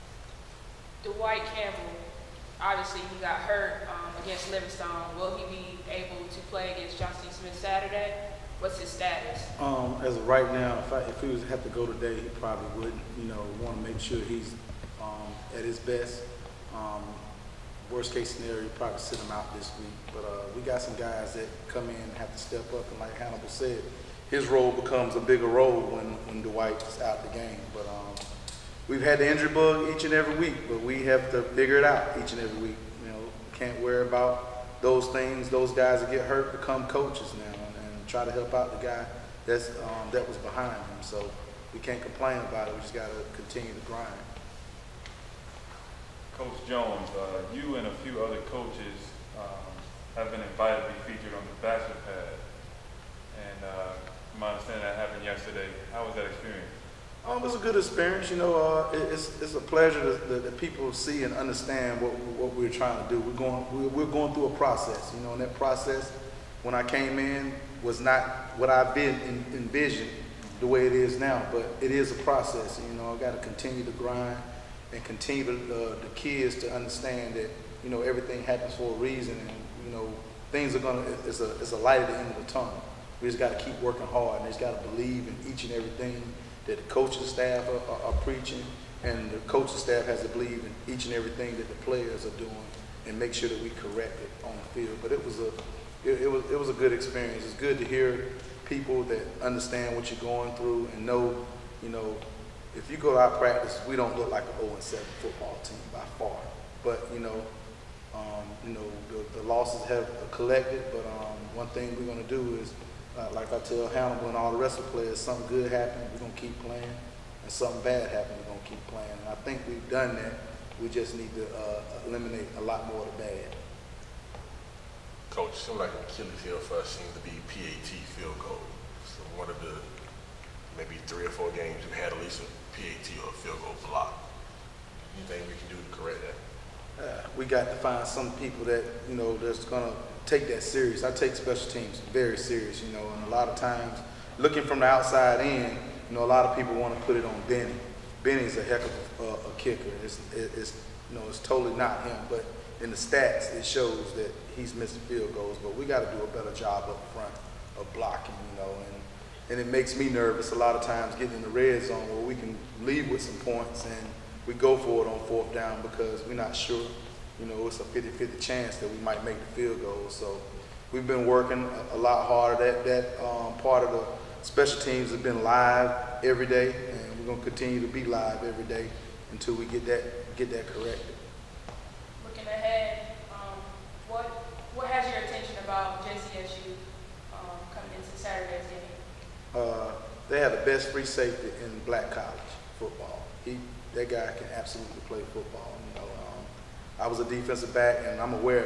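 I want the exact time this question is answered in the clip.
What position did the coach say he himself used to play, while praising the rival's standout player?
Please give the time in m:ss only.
3:17.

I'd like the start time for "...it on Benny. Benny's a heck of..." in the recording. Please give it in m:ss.
2:27.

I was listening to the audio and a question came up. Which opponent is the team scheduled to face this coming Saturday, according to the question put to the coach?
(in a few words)
Johnson C. Smith.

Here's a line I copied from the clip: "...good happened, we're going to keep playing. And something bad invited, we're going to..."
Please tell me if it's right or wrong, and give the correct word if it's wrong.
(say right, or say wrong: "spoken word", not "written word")
wrong: "happened", not "invited".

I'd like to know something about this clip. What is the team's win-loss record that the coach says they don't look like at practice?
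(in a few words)
0-7.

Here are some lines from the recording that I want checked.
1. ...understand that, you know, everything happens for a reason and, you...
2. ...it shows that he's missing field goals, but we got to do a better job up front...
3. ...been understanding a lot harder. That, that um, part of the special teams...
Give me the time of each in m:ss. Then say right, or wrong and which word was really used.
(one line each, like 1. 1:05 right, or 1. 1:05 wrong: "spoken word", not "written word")
1. 1:16 right
2. 2:33 right
3. 2:51 wrong: "working", not "understanding".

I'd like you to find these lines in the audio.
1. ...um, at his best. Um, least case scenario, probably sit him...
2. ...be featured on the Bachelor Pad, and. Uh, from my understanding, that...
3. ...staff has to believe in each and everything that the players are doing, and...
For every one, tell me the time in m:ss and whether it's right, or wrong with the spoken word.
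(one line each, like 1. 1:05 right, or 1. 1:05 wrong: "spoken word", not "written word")
1. 0:15 wrong: "worst", not "least"
2. 0:50 right
3. 1:29 right.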